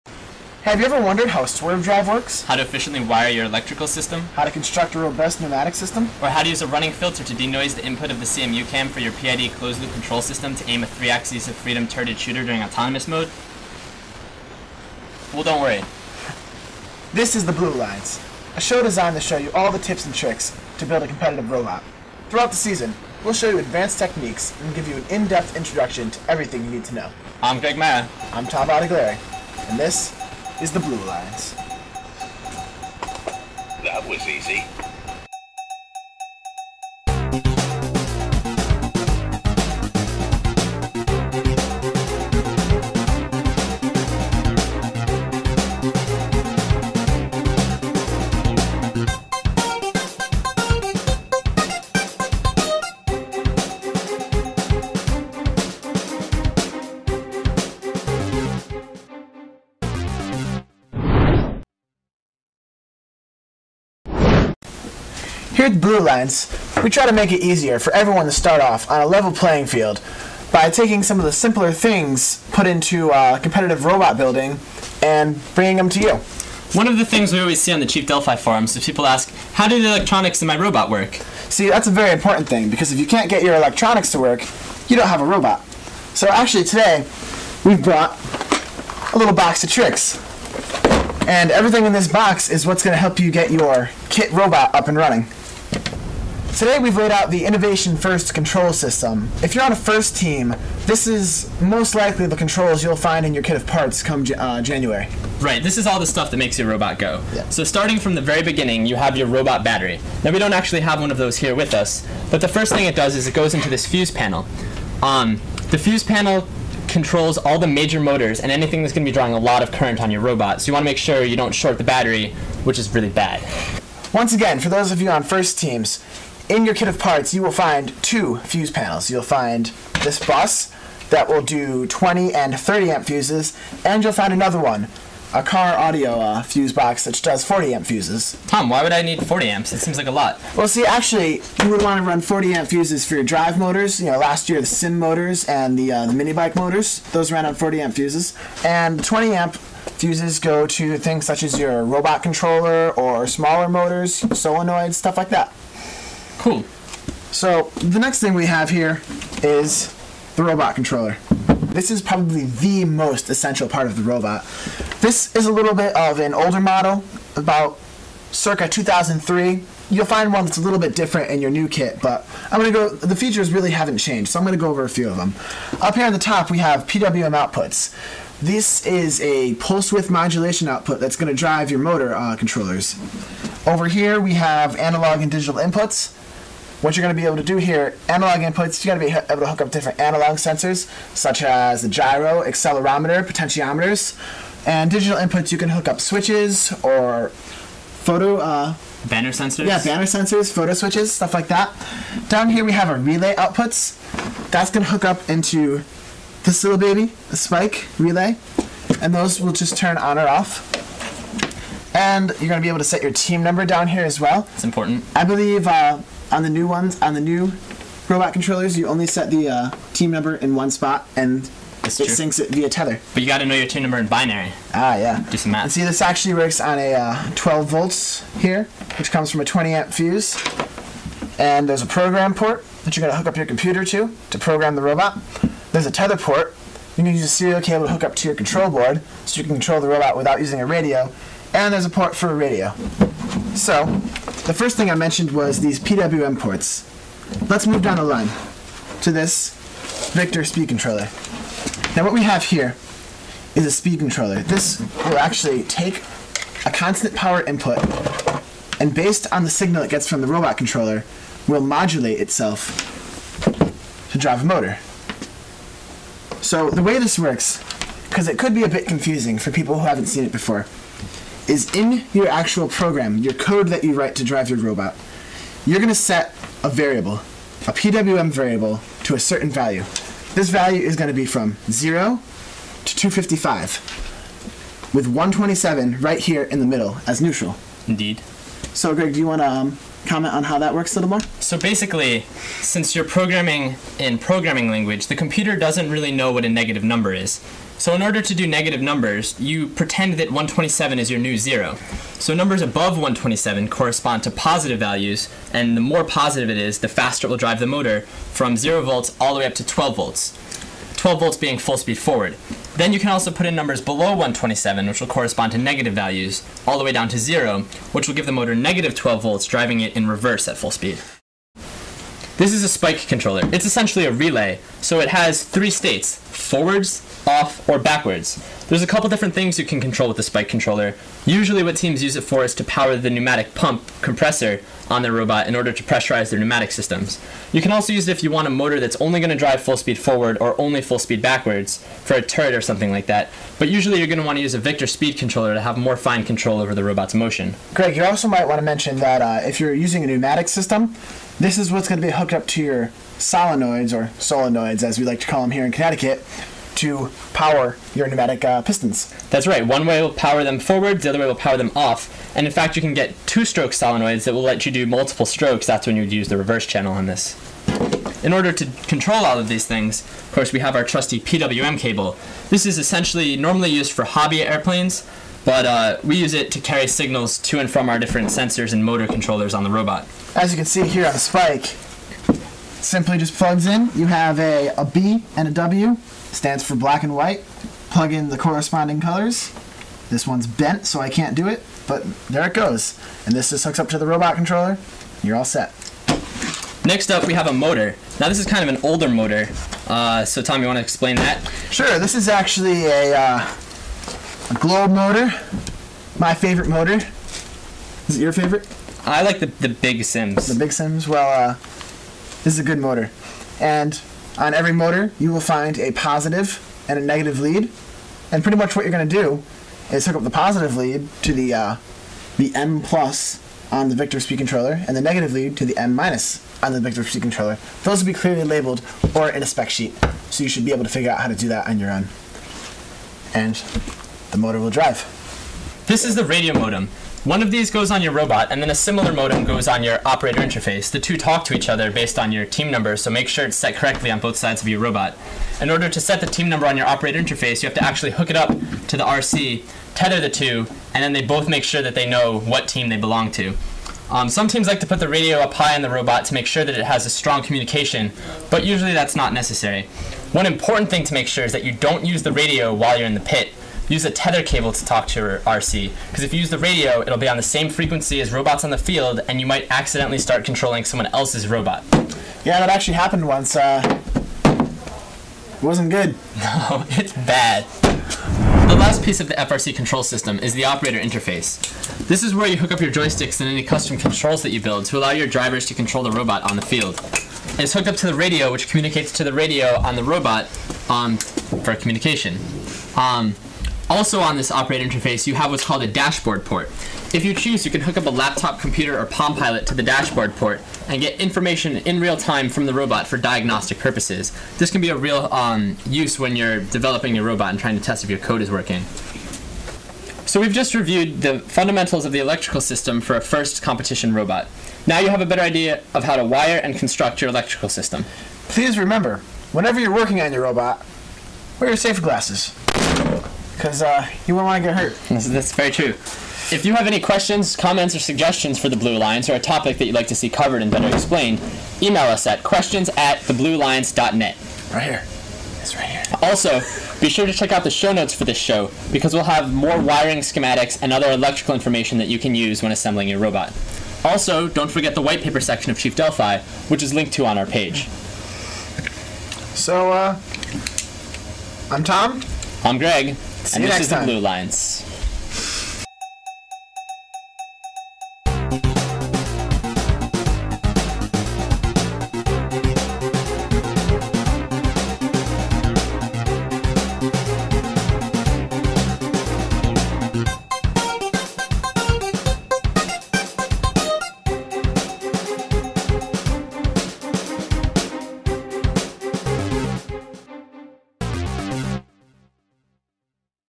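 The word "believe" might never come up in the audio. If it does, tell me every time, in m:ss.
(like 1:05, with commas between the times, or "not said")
3:35.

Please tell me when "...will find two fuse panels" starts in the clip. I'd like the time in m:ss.
2:07.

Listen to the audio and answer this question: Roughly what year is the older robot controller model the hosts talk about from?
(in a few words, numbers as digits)
2003.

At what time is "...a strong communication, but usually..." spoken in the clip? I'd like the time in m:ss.
7:37.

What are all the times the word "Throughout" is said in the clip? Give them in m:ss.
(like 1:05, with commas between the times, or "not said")
0:22.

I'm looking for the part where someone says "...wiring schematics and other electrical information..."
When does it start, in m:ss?
8:59.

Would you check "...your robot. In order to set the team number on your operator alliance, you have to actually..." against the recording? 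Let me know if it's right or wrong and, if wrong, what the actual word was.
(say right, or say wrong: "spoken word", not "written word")
wrong: "interface", not "alliance".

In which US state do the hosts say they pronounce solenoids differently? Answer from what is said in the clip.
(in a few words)
Connecticut.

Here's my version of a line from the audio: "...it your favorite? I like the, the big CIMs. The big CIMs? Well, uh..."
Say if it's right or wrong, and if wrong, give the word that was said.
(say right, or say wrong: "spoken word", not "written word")
right.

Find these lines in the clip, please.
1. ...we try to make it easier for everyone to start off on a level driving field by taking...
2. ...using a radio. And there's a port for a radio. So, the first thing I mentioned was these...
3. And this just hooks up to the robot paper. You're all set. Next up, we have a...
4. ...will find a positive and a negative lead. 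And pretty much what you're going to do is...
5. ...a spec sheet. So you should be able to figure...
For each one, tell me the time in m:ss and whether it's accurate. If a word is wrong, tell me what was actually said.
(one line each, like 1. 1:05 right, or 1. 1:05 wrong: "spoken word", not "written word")
1. 1:06 wrong: "playing", not "driving"
2. 4:00 right
3. 6:33 wrong: "controller", not "paper"
4. 6:55 right
5. 7:09 right.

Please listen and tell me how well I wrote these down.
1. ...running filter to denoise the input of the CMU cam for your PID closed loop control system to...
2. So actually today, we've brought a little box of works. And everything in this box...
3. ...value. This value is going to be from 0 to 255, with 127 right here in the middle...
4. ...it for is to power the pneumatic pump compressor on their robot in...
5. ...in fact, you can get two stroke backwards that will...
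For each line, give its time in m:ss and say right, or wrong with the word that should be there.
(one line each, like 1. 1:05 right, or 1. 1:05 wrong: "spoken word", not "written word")
1. 0:06 right
2. 1:26 wrong: "tricks", not "works"
3. 4:39 right
4. 5:32 right
5. 6:02 wrong: "solenoids", not "backwards".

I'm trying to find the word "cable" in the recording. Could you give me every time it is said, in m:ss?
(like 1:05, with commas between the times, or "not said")
3:57, 6:11, 7:44.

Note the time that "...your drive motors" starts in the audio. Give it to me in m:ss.
2:23.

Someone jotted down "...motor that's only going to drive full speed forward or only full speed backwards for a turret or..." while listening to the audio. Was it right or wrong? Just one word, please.
right.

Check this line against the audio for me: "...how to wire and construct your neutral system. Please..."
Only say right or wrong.
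wrong.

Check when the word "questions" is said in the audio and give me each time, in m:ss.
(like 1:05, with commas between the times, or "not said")
8:46, 8:52.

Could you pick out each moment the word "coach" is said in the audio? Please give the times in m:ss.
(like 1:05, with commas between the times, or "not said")
not said.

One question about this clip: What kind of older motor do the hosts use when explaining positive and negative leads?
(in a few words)
globe motor.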